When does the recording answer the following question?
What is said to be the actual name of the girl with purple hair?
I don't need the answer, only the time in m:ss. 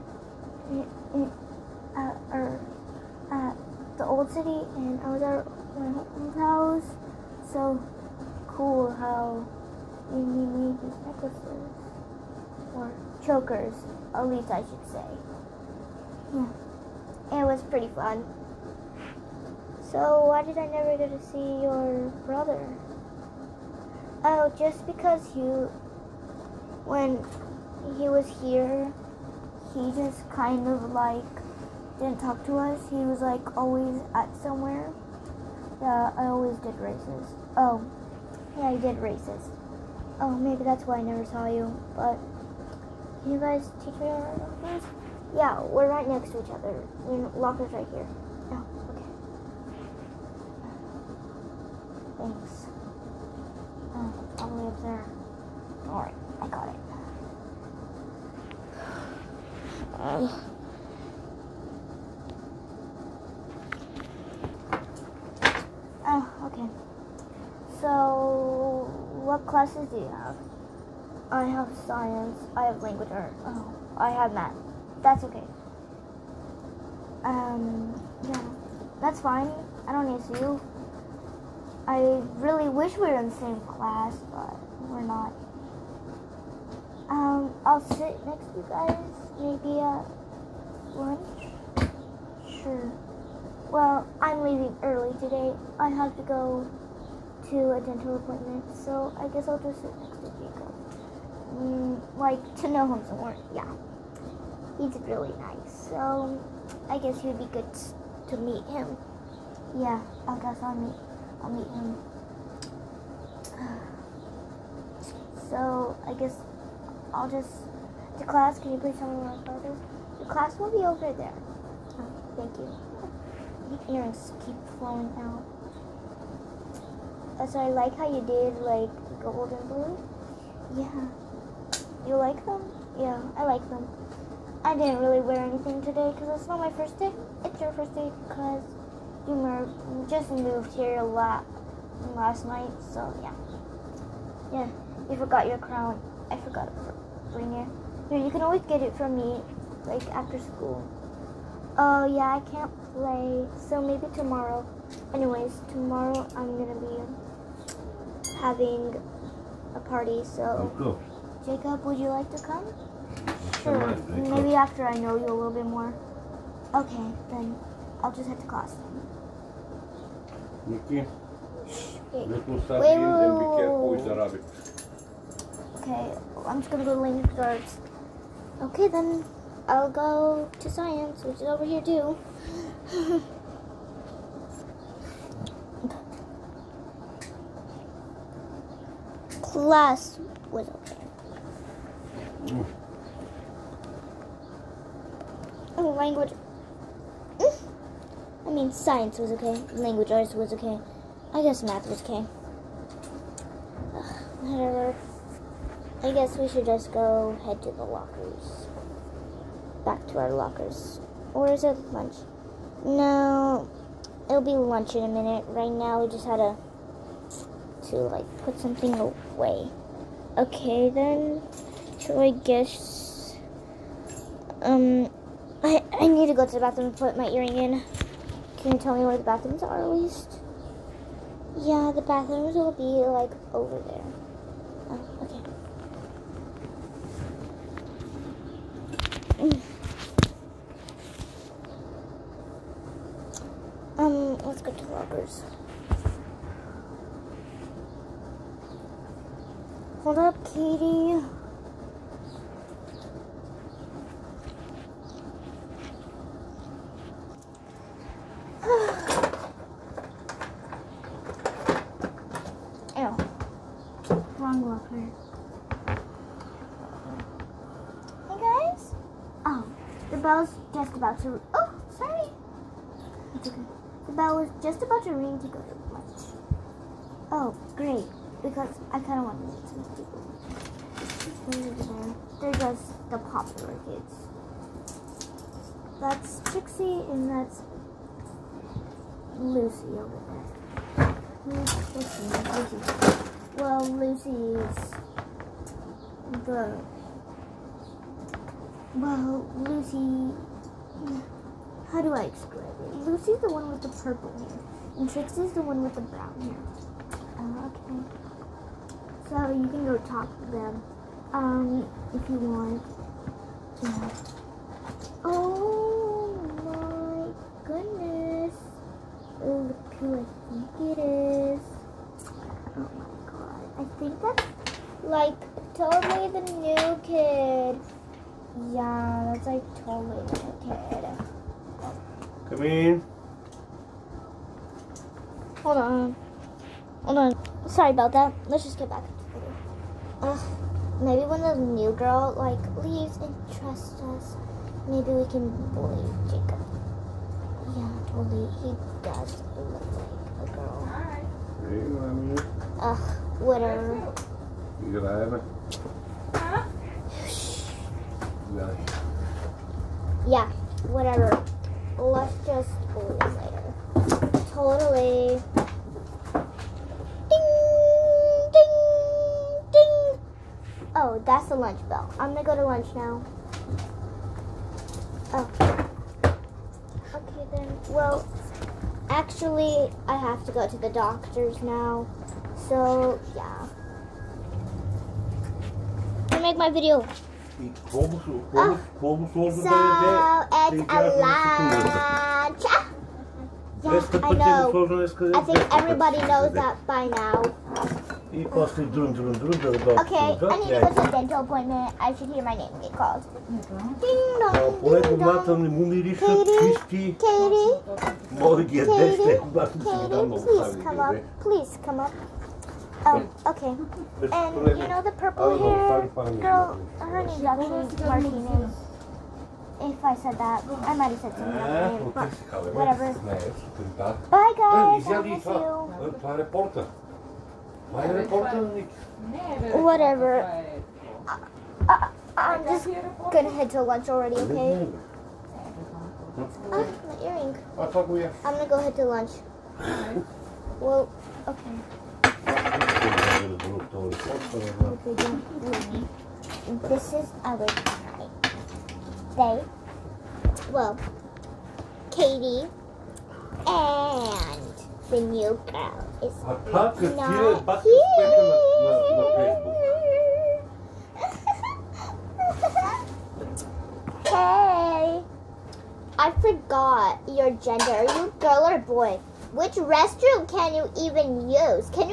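6:58.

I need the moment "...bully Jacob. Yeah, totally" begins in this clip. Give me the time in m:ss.
5:45.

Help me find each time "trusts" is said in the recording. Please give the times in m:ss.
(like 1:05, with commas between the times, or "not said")
5:43.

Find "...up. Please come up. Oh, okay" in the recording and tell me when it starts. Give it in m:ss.
6:50.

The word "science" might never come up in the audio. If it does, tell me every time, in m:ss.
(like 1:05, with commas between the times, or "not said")
1:11, 3:00, 3:18.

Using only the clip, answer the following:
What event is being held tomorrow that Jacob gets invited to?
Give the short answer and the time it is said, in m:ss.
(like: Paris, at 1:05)
A party, at 2:39.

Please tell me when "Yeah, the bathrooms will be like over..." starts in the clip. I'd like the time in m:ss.
3:51.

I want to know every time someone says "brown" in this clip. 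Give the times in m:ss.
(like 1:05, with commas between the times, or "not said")
5:05.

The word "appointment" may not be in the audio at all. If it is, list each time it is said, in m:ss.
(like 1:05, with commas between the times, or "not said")
1:38, 6:41.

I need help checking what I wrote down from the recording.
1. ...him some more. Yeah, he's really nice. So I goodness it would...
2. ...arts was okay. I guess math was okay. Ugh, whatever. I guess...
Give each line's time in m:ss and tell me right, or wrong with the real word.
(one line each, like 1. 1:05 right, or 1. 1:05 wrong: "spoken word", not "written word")
1. 1:42 wrong: "guess", not "goodness"
2. 3:20 right.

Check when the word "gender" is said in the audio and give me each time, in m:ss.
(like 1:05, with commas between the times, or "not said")
7:47.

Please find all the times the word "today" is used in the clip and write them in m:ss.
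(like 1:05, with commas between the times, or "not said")
1:35, 2:15.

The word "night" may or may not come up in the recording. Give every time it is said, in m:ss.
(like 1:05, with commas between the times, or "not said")
2:22.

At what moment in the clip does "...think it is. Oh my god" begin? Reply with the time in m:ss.
5:20.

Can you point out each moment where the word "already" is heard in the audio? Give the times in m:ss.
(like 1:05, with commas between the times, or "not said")
7:14.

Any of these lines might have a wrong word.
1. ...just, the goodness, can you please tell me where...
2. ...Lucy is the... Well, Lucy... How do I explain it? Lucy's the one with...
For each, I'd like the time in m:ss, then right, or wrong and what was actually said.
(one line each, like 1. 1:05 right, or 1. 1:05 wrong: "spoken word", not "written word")
1. 1:57 wrong: "class", not "goodness"
2. 4:53 right.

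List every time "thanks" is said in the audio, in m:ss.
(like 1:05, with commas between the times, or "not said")
0:52, 2:02.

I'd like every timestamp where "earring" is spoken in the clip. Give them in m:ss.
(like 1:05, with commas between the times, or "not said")
2:03, 3:47, 7:17.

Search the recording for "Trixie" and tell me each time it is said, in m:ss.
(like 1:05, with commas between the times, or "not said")
4:46, 5:05.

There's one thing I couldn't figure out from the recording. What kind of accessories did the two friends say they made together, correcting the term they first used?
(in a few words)
Chokers.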